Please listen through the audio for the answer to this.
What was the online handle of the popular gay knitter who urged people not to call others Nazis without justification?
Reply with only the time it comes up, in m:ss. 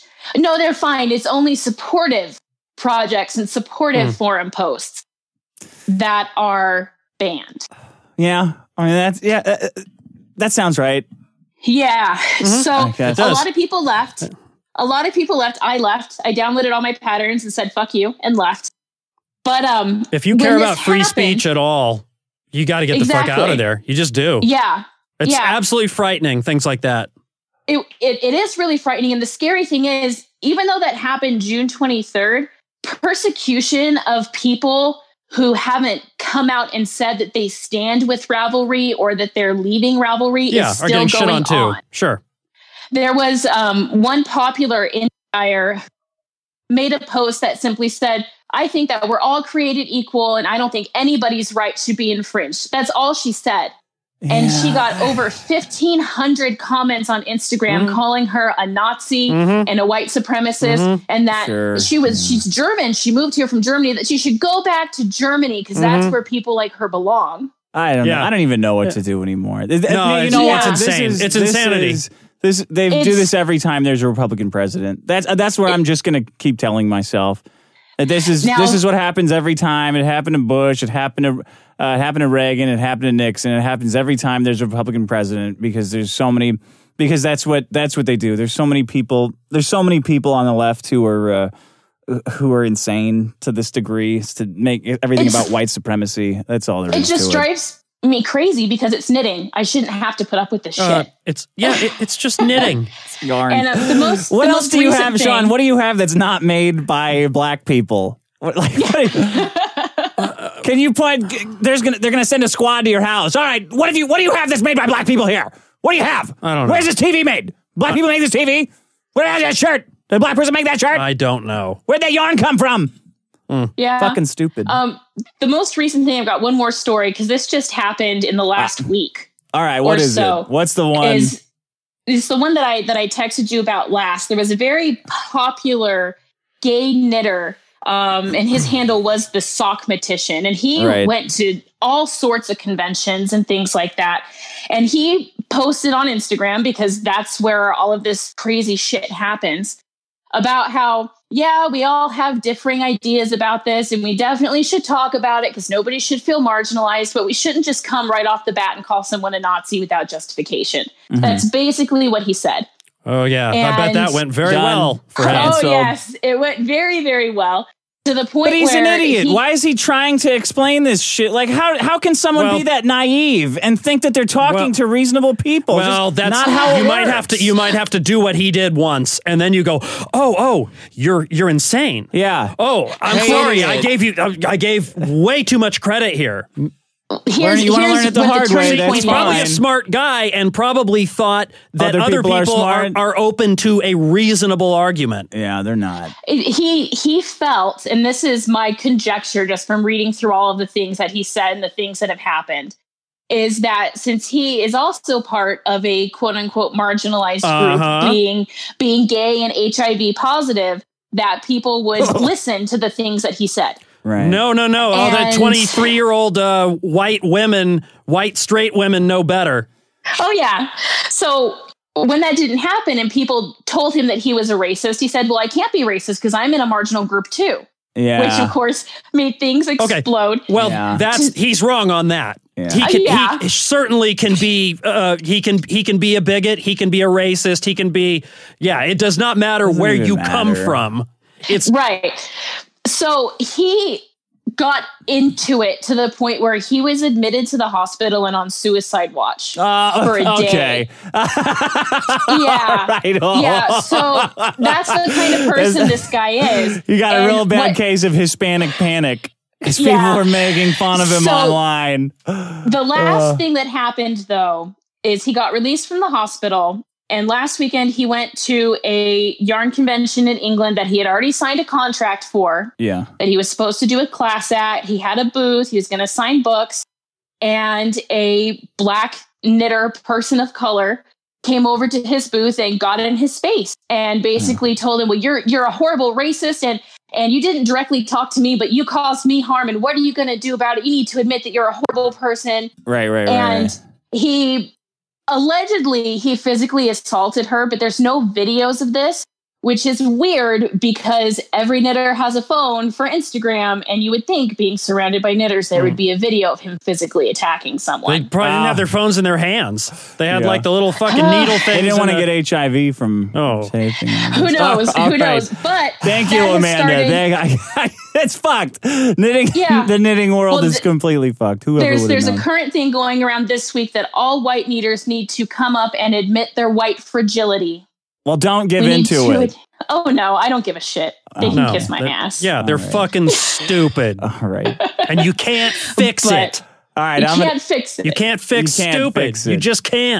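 2:19.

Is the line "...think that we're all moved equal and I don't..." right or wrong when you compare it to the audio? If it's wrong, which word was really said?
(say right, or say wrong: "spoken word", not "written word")
wrong: "created", not "moved".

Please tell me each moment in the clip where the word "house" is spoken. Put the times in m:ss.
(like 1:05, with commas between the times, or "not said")
1:53.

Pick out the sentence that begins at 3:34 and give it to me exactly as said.
All that 23 year old uh, white women, white straight women know better.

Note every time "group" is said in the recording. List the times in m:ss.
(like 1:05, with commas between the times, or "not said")
3:27, 3:47.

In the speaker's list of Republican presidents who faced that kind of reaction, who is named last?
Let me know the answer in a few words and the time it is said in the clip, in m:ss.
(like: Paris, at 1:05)
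Nixon, at 1:23.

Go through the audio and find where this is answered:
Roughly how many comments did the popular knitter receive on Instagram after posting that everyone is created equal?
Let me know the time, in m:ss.
0:55.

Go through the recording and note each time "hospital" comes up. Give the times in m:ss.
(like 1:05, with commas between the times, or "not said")
4:07, 4:26.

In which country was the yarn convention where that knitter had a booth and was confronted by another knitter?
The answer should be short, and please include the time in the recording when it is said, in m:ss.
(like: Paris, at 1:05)
England, at 4:30.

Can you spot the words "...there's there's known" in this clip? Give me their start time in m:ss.
5:21.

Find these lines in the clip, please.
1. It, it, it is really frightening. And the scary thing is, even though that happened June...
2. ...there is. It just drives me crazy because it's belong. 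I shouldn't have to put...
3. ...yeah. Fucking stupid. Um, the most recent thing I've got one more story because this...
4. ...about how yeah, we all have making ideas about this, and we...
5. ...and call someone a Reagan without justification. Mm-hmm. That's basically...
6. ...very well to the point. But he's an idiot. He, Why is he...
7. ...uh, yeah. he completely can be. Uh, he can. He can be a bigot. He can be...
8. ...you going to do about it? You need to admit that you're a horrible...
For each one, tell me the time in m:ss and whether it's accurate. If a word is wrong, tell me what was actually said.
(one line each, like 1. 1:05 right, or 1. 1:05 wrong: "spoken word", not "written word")
1. 0:27 right
2. 1:36 wrong: "knitting", not "belong"
3. 2:03 right
4. 2:30 wrong: "differing", not "making"
5. 2:38 wrong: "Nazi", not "Reagan"
6. 2:47 right
7. 3:53 wrong: "certainly", not "completely"
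8. 4:49 right.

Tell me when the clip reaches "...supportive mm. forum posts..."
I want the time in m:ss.
0:03.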